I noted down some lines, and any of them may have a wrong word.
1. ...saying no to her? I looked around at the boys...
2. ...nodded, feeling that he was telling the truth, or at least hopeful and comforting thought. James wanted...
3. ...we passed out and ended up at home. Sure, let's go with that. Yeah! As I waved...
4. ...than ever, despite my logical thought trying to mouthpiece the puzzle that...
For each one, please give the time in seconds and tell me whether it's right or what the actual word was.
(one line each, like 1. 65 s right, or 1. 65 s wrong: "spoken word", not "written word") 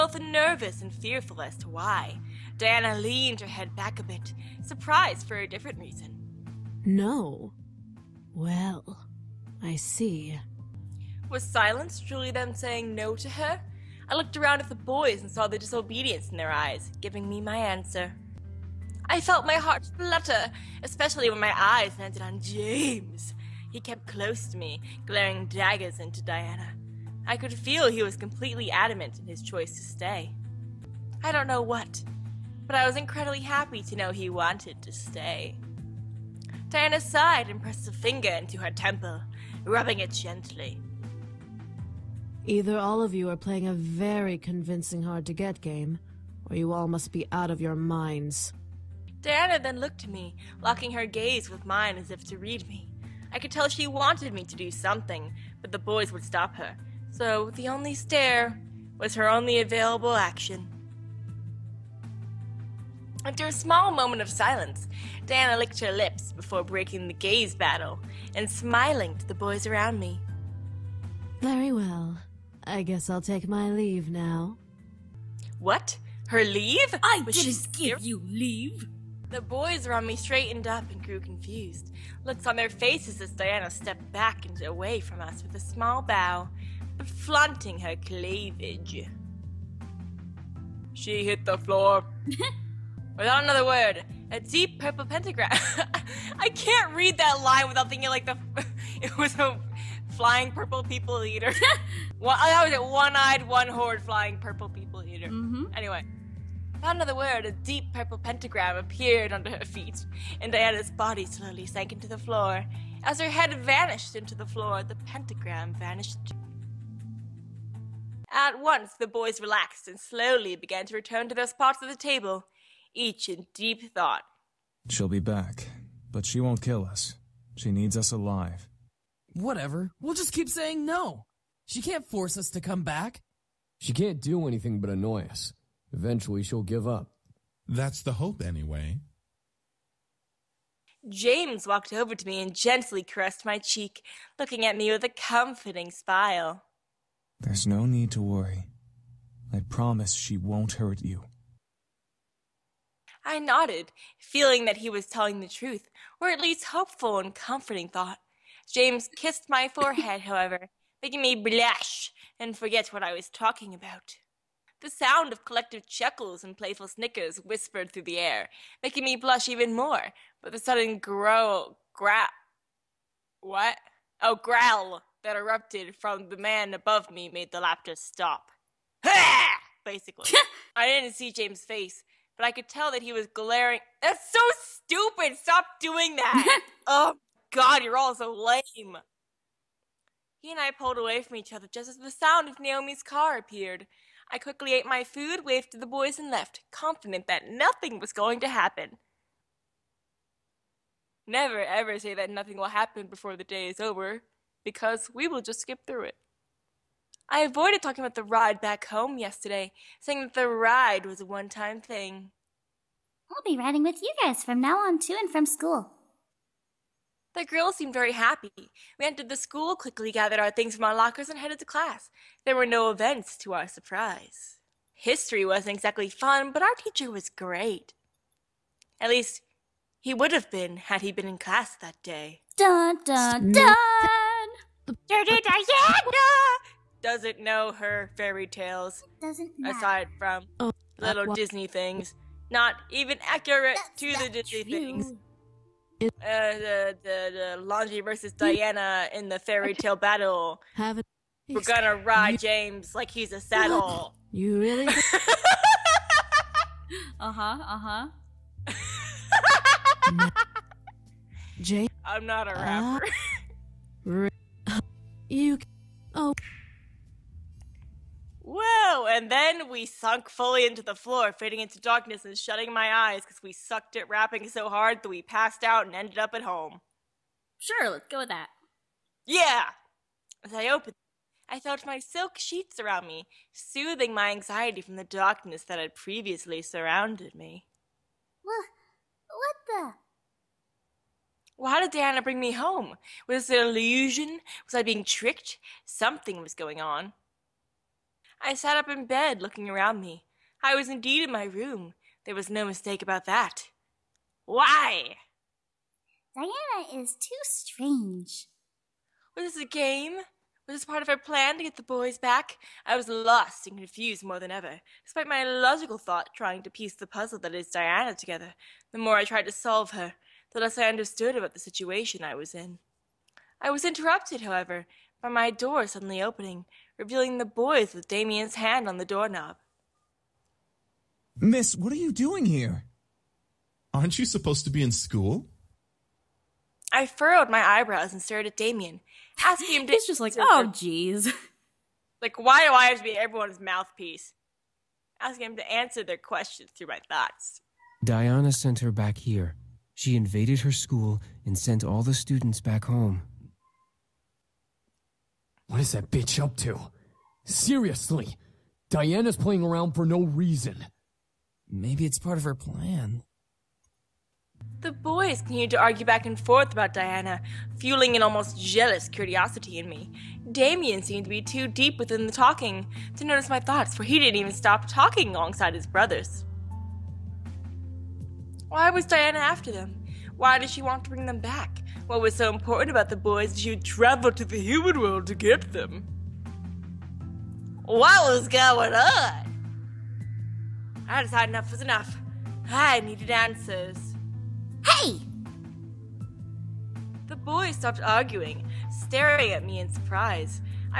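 1. 12 s right
2. 153 s wrong: "kissed", not "wanted"
3. 275 s wrong: "opened", not "waved"
4. 314 s wrong: "piece", not "mouthpiece".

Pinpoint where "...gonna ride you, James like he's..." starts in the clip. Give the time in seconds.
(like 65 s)
251 s.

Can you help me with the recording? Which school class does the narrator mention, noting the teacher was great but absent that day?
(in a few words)
History.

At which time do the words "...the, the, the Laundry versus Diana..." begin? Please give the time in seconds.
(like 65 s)
246 s.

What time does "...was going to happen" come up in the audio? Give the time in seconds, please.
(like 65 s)
197 s.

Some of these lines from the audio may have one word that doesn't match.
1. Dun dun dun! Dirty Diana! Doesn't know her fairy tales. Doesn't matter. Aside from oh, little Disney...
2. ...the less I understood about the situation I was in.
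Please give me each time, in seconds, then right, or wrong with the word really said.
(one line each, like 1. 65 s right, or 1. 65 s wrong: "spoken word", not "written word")
1. 232 s right
2. 320 s right.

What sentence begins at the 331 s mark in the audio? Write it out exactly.
Miss, what are you doing here?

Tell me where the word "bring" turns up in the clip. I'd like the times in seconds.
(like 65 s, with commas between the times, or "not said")
292 s, 381 s.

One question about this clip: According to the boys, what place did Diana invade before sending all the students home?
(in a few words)
her school.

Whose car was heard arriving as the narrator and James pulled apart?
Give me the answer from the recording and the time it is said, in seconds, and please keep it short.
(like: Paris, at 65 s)
Naomi's, at 192 s.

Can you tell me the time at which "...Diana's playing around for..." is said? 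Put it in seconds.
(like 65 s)
358 s.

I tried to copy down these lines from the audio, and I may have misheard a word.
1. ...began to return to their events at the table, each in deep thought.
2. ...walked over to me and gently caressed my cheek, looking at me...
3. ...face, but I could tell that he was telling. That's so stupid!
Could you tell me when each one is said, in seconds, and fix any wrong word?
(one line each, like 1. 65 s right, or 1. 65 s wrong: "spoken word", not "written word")
1. 120 s wrong: "spots", not "events"
2. 141 s right
3. 181 s wrong: "glaring", not "telling".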